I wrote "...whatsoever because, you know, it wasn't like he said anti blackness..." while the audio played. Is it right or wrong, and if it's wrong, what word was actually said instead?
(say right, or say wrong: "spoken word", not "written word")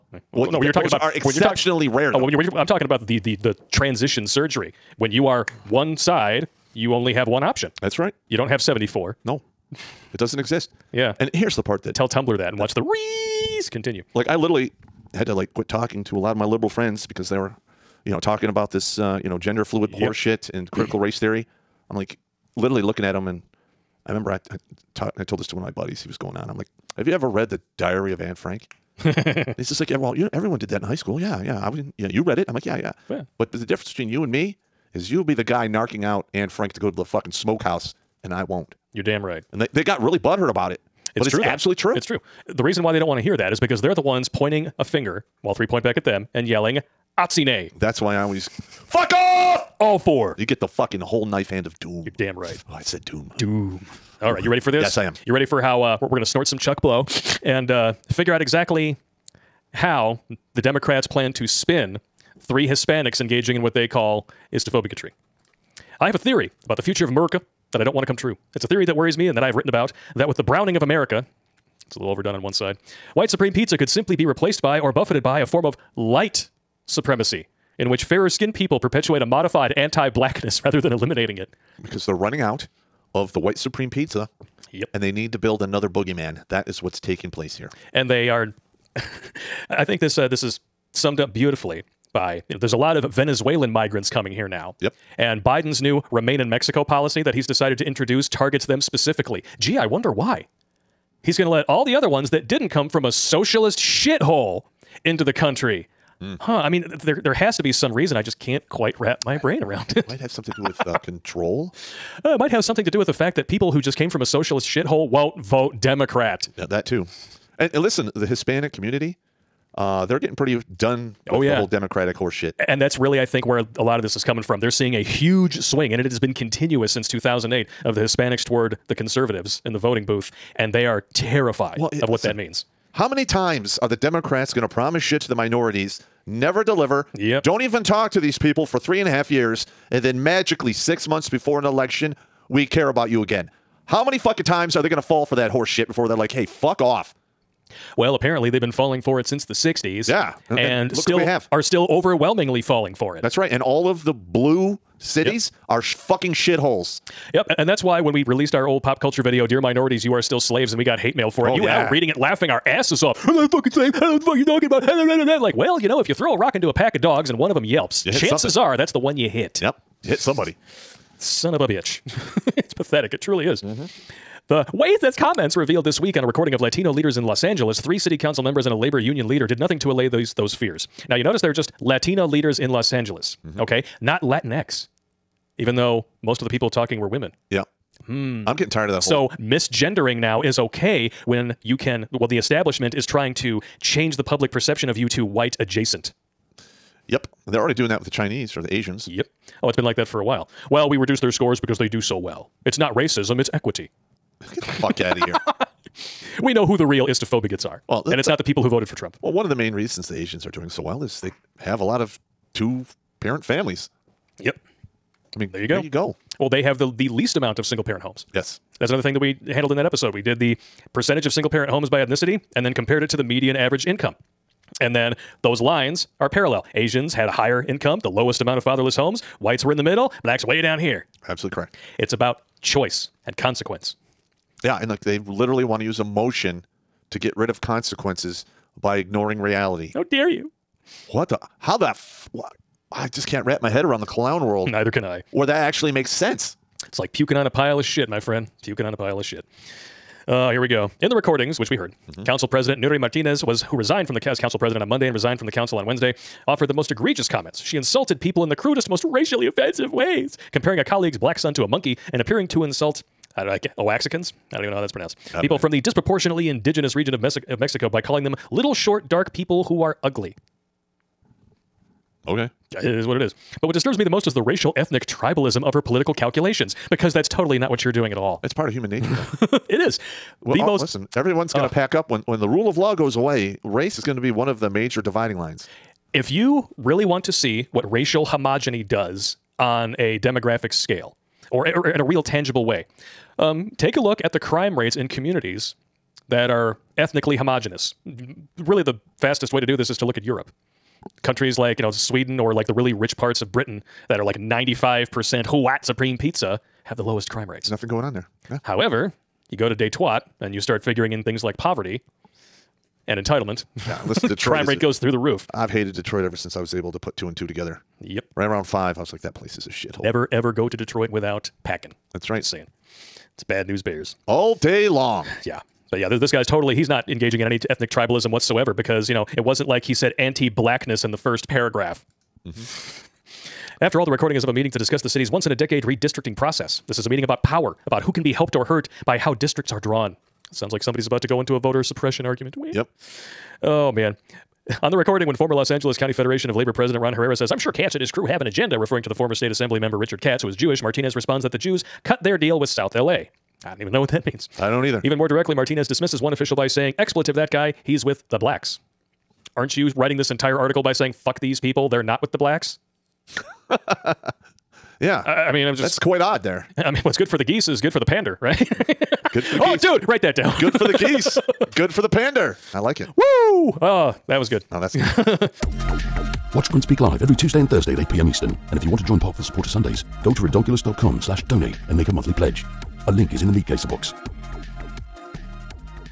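right.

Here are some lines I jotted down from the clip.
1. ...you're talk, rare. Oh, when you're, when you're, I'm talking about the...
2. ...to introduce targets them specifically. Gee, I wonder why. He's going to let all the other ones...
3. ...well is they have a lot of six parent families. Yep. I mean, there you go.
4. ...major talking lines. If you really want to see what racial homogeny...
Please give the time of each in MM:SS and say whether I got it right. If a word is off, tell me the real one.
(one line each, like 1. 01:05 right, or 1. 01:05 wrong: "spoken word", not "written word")
1. 00:02 right
2. 01:37 right
3. 03:30 wrong: "two", not "six"
4. 04:44 wrong: "dividing", not "talking".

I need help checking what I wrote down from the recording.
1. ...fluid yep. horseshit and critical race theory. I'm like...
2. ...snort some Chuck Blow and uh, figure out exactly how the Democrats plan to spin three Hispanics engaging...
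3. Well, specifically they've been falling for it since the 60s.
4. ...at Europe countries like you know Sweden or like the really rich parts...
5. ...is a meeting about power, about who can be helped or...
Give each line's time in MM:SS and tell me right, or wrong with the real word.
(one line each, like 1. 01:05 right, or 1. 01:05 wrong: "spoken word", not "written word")
1. 00:19 right
2. 00:56 right
3. 02:27 wrong: "apparently", not "specifically"
4. 05:00 right
5. 05:36 right.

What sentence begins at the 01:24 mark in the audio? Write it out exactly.
And they need to build another boogeyman.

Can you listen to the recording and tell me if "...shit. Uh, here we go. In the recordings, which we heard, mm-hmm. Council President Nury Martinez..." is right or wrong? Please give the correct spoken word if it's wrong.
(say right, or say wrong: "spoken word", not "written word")
right.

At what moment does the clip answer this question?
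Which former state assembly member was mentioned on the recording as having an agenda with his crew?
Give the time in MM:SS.
05:49.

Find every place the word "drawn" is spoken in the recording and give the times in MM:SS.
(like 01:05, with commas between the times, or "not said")
05:39.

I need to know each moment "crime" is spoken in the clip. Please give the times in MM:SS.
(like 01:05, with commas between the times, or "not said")
04:54, 05:07, 05:14.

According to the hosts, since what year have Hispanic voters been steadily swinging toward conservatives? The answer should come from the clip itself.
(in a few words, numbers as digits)
2008.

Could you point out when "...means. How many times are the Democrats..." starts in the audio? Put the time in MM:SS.
02:12.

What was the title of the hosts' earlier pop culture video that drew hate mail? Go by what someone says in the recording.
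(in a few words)
Dear Minorities, You Are Still Slaves.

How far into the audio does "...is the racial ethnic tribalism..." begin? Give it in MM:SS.
04:34.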